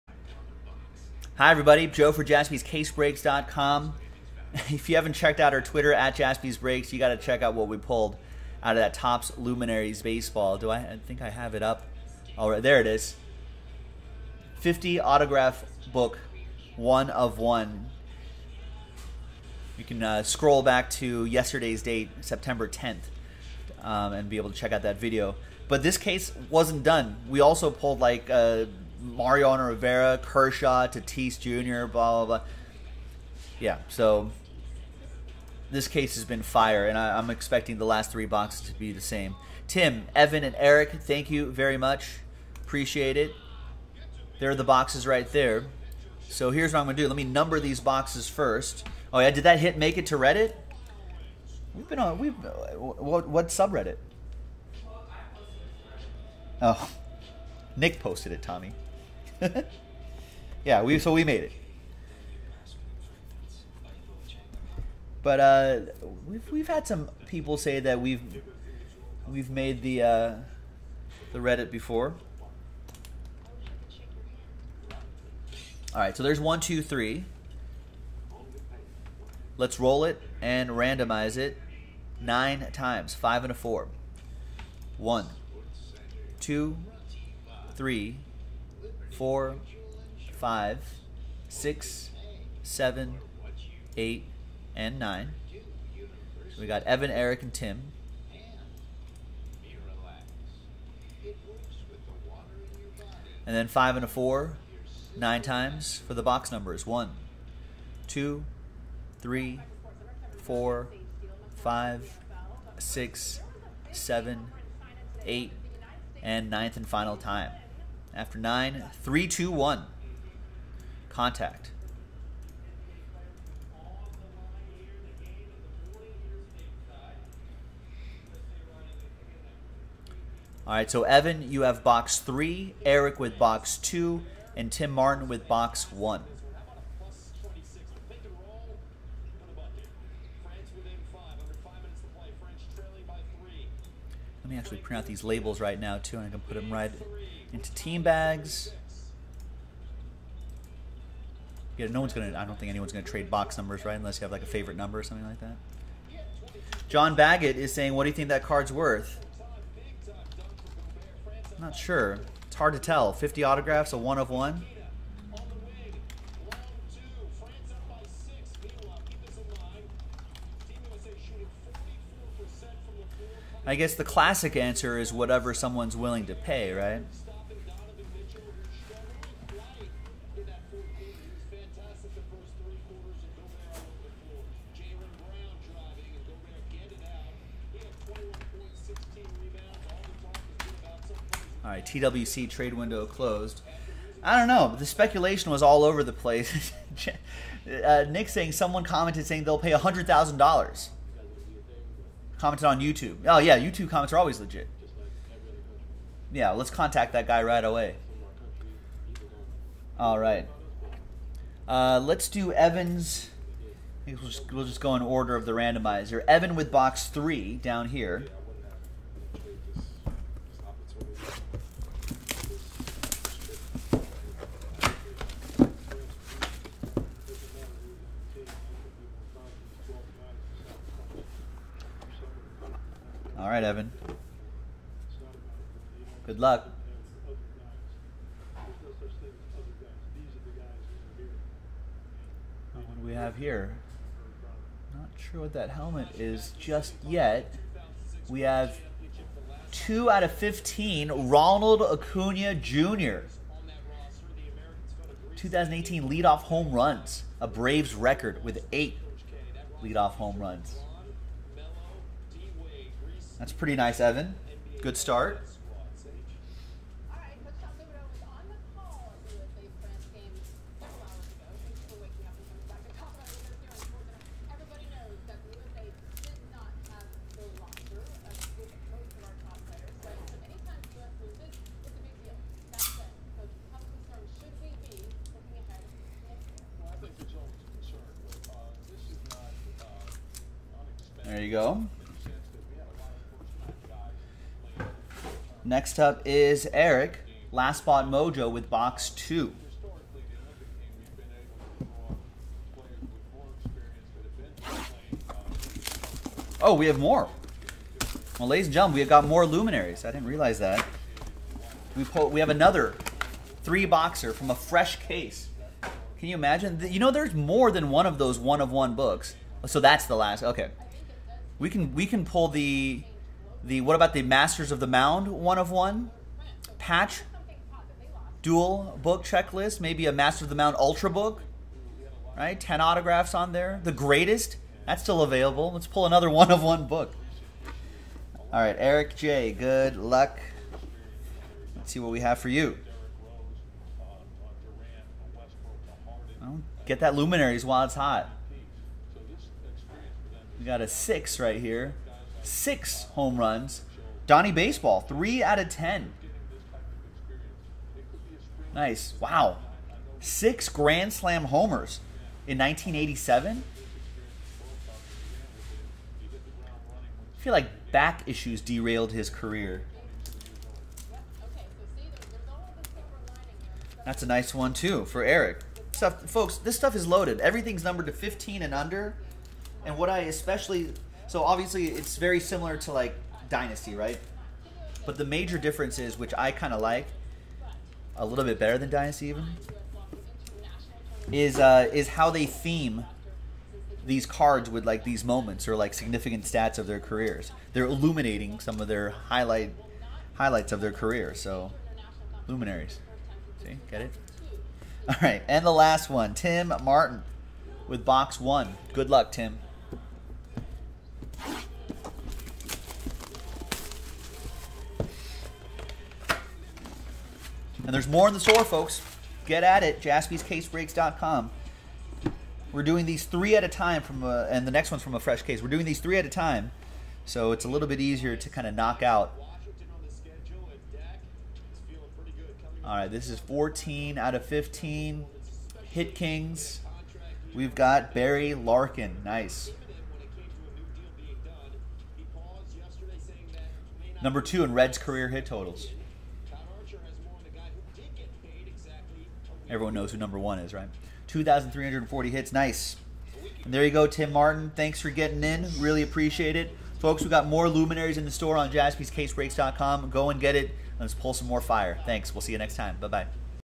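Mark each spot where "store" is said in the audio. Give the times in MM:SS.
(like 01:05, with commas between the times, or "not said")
06:58, 07:38.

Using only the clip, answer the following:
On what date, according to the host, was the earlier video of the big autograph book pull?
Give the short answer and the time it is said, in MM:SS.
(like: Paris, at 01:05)
September 10th, at 00:22.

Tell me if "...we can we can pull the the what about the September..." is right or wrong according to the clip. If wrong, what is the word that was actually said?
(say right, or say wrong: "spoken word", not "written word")
wrong: "Masters", not "September".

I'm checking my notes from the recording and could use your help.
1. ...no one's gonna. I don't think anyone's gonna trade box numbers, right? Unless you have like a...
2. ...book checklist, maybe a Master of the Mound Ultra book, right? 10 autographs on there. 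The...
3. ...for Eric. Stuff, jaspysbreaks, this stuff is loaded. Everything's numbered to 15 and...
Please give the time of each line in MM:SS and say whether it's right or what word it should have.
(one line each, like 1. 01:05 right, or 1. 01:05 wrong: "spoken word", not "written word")
1. 02:31 right
2. 05:29 right
3. 06:15 wrong: "folks", not "jaspysbreaks".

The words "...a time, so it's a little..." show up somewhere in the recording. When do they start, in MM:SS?
07:06.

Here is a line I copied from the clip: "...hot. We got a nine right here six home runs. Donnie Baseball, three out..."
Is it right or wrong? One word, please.
wrong.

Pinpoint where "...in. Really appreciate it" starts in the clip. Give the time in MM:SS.
07:35.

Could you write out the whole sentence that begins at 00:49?
Oh, yeah, did that hit make it to Reddit?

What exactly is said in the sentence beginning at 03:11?
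All right, TWC trade window closed.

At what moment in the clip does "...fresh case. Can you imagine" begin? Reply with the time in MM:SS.
05:14.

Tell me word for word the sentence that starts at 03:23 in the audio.
Oh yeah, YouTube comments are always legit.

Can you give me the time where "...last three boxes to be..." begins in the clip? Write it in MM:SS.
00:37.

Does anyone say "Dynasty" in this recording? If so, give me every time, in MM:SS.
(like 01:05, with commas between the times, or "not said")
06:23, 06:28.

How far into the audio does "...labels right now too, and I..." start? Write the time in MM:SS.
02:25.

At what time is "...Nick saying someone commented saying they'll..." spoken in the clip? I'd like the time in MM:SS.
03:18.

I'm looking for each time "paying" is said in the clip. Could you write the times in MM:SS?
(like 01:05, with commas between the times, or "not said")
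not said.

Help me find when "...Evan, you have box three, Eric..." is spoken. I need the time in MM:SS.
02:11.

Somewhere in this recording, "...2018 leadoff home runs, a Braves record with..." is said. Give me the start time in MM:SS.
04:15.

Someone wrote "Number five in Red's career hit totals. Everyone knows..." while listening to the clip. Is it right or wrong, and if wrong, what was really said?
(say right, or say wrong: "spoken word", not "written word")
wrong: "two", not "five".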